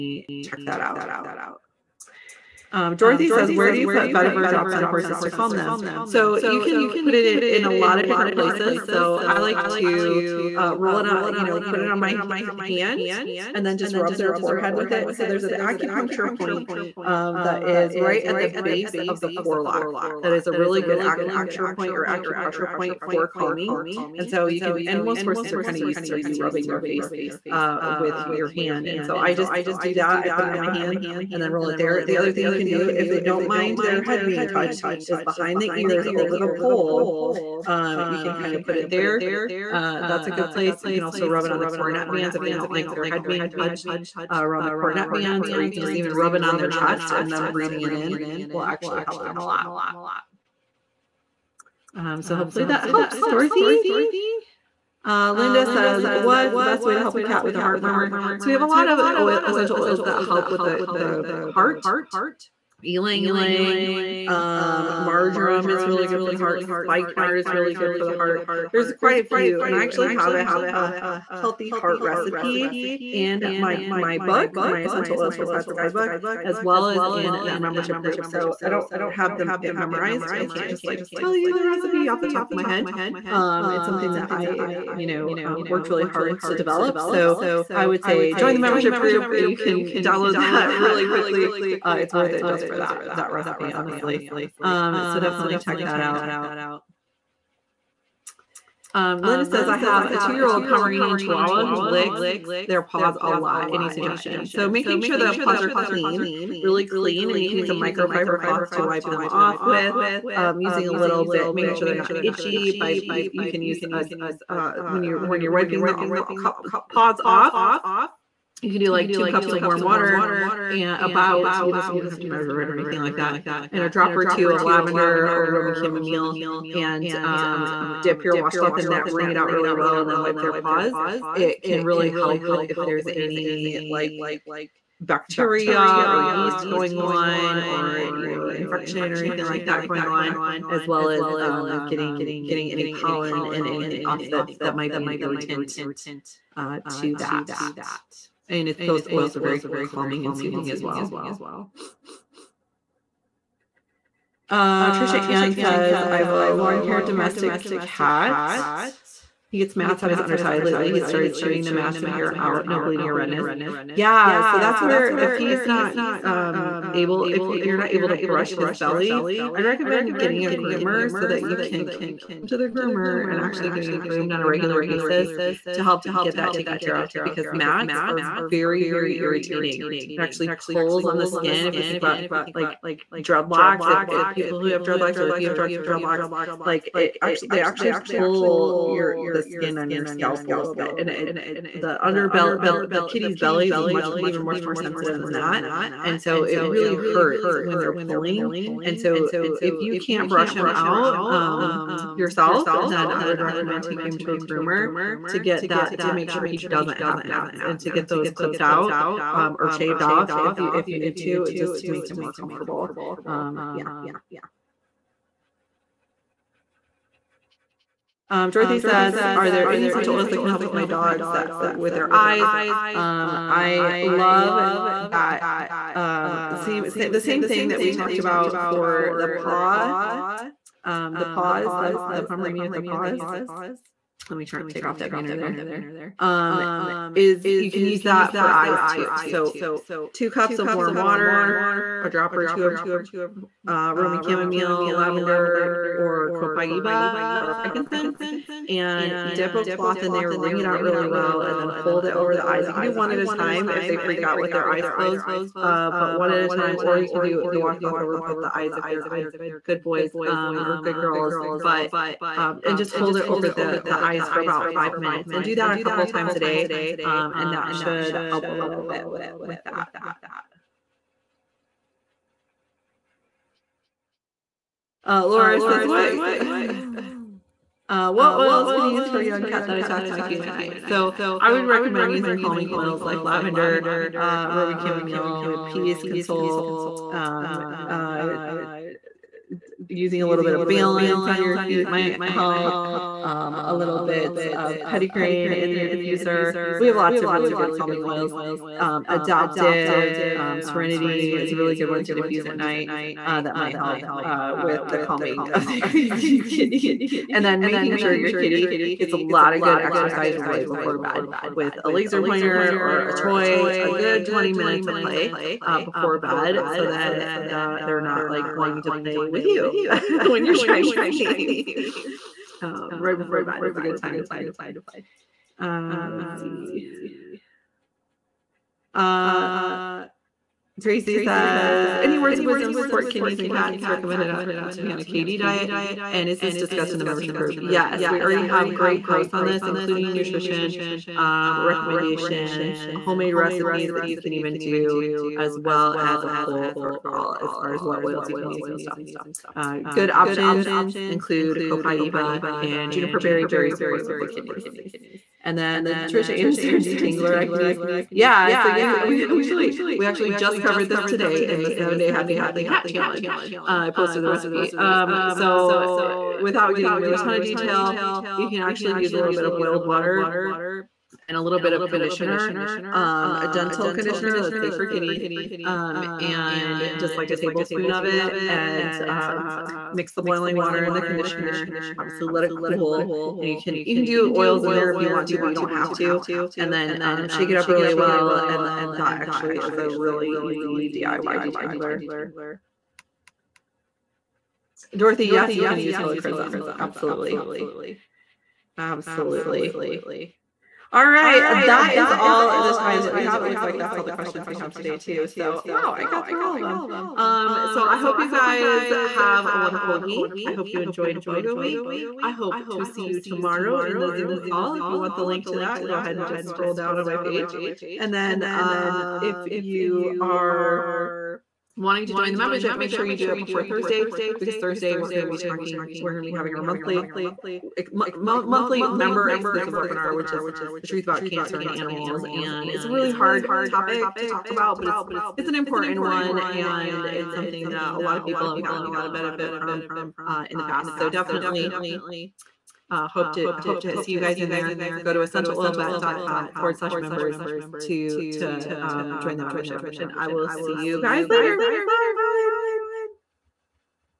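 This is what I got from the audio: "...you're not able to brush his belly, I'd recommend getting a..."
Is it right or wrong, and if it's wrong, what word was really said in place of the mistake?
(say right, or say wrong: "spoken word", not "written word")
right.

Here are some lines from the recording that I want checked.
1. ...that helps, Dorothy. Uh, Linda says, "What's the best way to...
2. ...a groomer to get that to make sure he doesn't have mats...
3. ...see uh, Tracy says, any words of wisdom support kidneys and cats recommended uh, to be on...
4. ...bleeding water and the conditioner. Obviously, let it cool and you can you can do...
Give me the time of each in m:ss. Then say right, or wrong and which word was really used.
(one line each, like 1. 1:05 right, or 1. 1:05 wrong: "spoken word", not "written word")
1. 0:52 right
2. 3:24 right
3. 5:26 right
4. 6:20 wrong: "boiling", not "bleeding".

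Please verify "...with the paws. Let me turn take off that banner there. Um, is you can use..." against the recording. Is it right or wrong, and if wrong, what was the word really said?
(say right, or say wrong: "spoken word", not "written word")
right.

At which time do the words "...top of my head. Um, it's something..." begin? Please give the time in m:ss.
1:22.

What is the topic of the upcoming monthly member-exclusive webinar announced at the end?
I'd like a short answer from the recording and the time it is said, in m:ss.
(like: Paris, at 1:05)
The truth about cancer and animals, at 7:10.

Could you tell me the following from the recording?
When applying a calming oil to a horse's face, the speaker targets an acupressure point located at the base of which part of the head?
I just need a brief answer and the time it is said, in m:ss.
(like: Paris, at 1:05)
Forelock, at 0:19.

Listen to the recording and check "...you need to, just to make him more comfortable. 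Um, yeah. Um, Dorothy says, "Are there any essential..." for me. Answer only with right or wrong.
right.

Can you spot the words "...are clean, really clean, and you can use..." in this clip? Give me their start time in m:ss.
1:45.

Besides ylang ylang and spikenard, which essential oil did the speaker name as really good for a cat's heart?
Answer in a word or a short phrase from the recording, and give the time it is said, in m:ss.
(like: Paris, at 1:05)
Marjoram, at 1:04.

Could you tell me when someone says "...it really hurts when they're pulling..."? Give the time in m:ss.
3:16.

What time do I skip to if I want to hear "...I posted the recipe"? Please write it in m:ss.
6:03.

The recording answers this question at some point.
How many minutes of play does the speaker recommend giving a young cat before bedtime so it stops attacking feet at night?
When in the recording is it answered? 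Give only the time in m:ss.
5:14.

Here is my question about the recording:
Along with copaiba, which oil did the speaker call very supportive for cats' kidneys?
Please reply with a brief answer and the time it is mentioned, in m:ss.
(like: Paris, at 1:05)
Juniper berry, at 5:52.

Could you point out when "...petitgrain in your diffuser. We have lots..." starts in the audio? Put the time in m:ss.
4:54.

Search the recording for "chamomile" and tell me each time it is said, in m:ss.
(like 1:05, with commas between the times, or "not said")
2:05, 4:04, 4:44.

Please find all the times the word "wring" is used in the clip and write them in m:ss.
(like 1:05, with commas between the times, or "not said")
2:09, 4:10.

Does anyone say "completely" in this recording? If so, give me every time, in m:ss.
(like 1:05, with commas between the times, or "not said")
not said.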